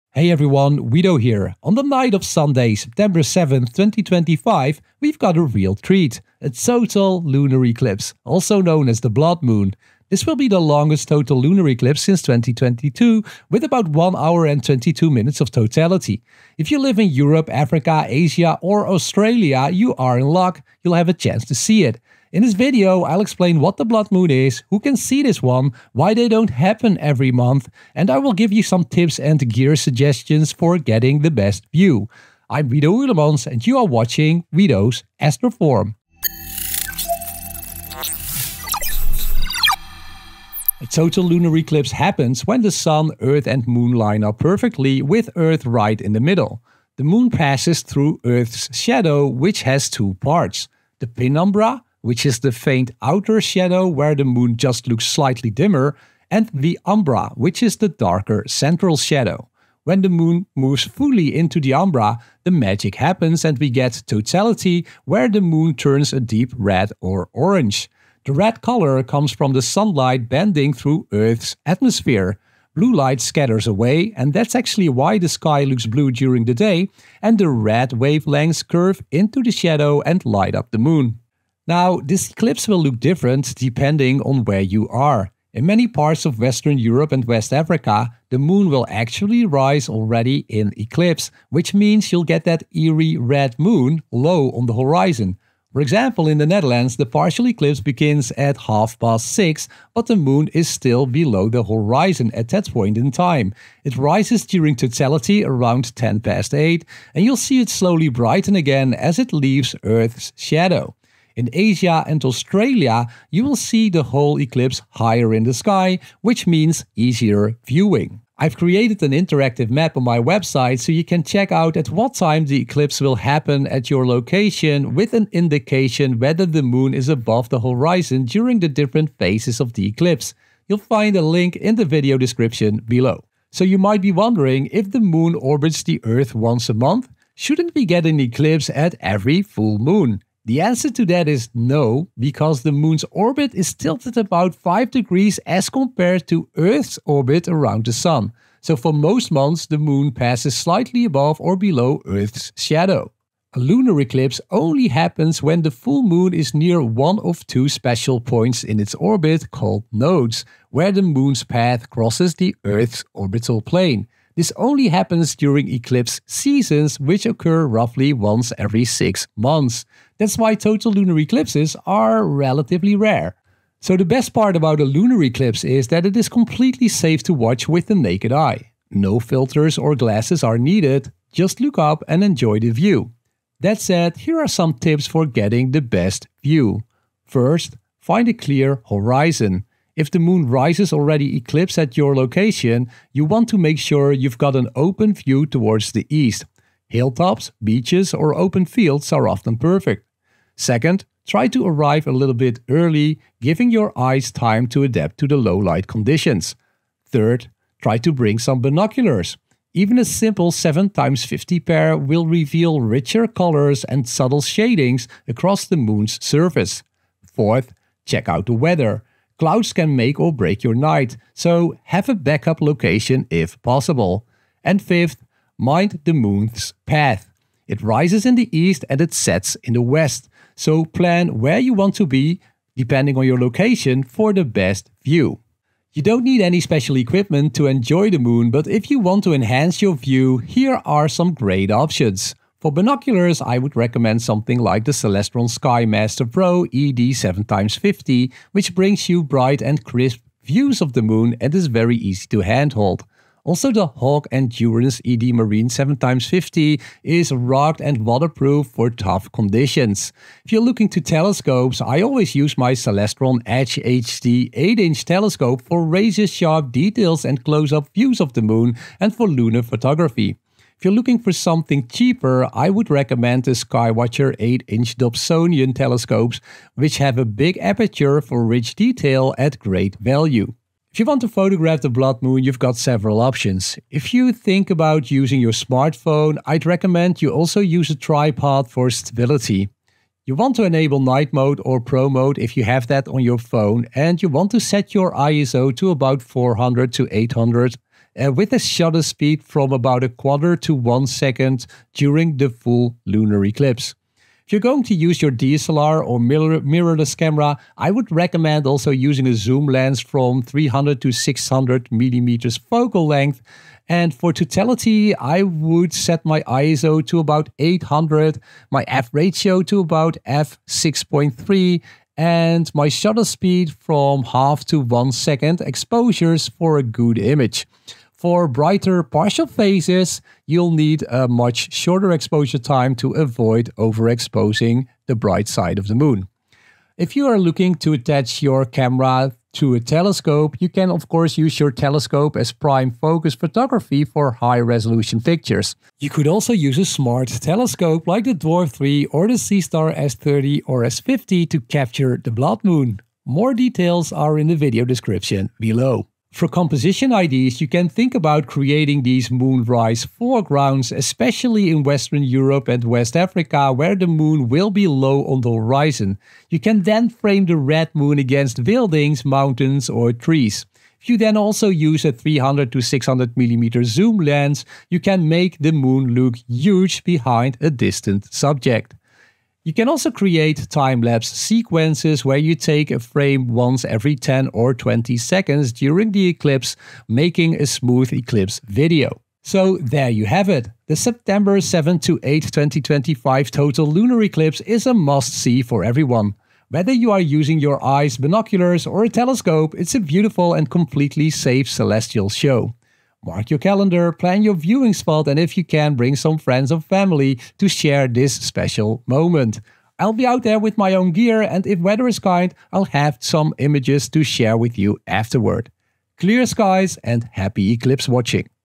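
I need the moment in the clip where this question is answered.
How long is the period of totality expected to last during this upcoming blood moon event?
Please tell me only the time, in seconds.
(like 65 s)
13 s.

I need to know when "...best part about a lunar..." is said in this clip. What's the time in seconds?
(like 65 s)
174 s.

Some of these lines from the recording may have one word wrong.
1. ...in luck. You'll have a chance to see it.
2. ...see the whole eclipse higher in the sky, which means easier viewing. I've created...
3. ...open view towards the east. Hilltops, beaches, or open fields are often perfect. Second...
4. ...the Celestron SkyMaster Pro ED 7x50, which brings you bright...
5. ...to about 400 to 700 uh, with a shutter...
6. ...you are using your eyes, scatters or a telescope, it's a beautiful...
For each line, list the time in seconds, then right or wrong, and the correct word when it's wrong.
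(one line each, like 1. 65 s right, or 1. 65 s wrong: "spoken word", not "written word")
1. 20 s right
2. 113 s right
3. 194 s right
4. 244 s right
5. 295 s wrong: "800", not "700"
6. 396 s wrong: "binoculars", not "scatters".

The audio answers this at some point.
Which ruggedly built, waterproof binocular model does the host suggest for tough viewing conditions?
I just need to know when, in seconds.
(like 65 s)
253 s.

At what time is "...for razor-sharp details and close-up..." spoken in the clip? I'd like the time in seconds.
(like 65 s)
265 s.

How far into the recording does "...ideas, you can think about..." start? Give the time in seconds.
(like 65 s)
357 s.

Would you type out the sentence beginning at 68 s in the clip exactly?
The red color comes from the sunlight bending through Earth's atmosphere.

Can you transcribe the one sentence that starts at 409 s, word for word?
I'll be out there with my own gear, and if weather is kind, I'll have some images to share with you afterward.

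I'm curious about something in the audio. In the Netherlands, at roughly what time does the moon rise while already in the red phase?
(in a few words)
8:10.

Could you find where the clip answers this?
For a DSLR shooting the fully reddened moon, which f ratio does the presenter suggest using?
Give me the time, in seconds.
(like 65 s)
320 s.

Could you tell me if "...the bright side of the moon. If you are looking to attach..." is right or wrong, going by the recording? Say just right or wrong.
right.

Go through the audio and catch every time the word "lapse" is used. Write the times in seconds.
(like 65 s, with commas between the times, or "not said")
380 s.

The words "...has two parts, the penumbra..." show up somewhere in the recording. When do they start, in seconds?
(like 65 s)
49 s.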